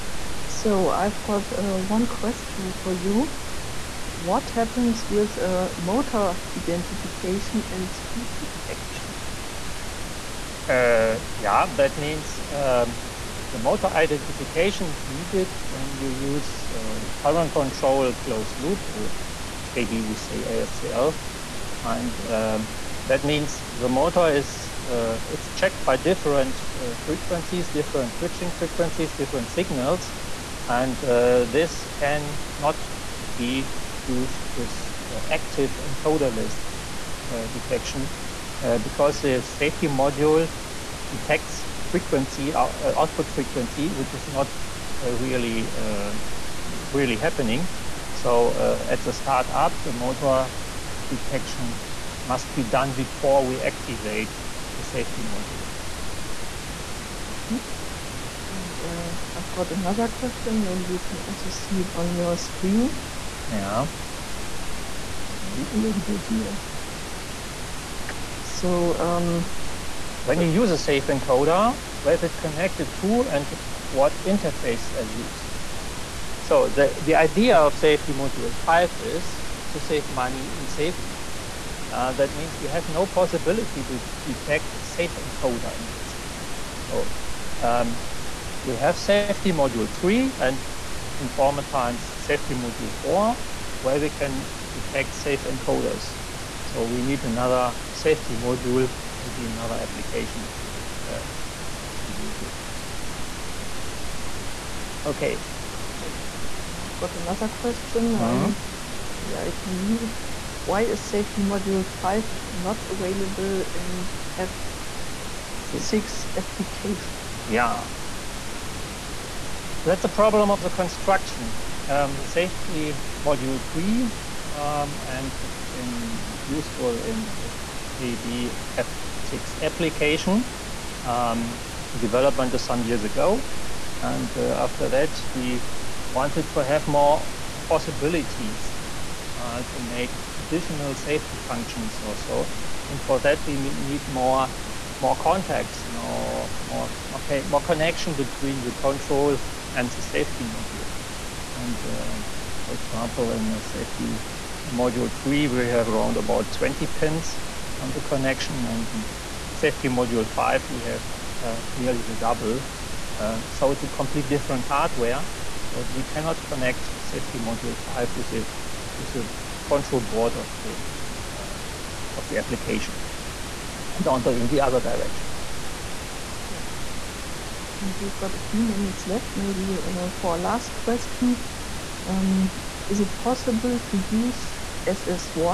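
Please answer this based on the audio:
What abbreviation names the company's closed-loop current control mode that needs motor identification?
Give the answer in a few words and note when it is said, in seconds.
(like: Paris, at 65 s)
ASCL, at 20 s.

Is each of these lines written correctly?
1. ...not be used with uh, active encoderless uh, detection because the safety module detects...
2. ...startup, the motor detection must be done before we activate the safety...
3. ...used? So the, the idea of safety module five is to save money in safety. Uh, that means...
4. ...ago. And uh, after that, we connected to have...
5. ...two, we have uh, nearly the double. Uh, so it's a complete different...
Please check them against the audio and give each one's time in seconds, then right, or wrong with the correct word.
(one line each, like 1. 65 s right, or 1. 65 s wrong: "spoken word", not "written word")
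1. 32 s right
2. 49 s right
3. 75 s right
4. 133 s wrong: "wanted", not "connected"
5. 160 s wrong: "five", not "two".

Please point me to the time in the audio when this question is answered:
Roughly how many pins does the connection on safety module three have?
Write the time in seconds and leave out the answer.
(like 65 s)
156 s.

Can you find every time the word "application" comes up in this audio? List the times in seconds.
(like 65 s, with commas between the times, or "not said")
99 s, 116 s, 129 s, 172 s.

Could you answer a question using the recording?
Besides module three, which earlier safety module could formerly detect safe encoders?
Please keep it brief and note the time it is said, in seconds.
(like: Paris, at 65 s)
safety module 4, at 92 s.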